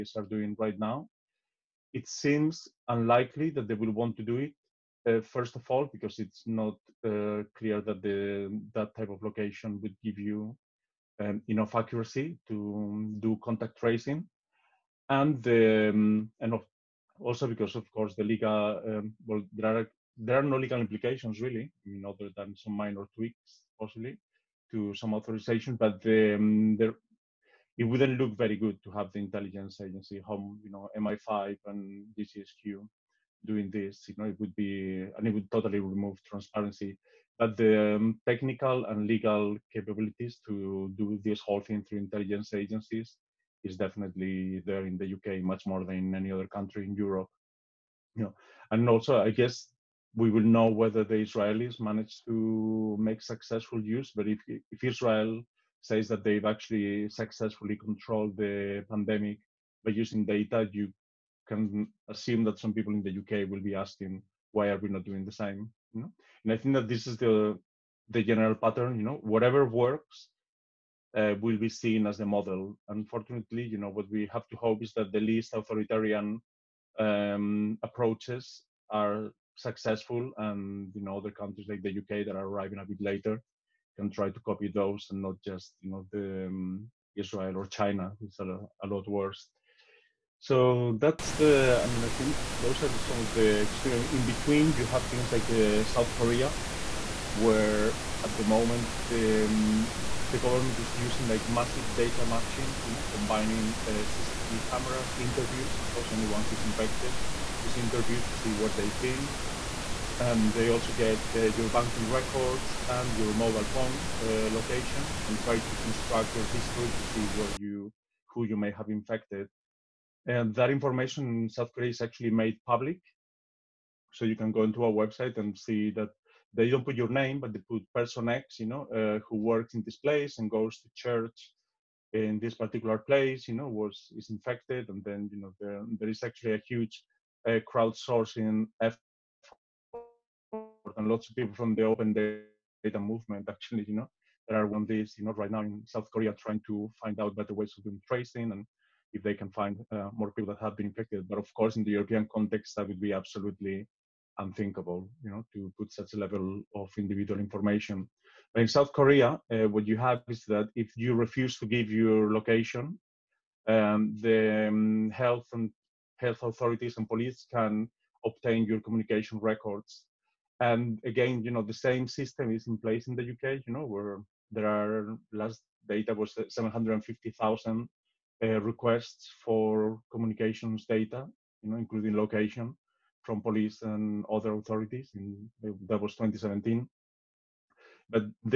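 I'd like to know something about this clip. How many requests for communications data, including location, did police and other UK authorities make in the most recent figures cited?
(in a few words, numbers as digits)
750,000.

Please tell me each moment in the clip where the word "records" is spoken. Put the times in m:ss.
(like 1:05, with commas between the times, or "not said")
1:52, 2:49.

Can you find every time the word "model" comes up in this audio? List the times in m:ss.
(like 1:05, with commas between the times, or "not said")
1:12.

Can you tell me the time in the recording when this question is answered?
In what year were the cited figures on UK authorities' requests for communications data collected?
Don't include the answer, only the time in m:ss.
3:06.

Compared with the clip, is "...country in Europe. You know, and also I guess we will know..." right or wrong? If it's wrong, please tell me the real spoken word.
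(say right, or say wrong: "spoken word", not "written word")
right.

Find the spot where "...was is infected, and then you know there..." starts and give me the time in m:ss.
2:13.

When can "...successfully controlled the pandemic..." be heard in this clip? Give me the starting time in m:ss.
0:57.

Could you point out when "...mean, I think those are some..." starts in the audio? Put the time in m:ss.
1:31.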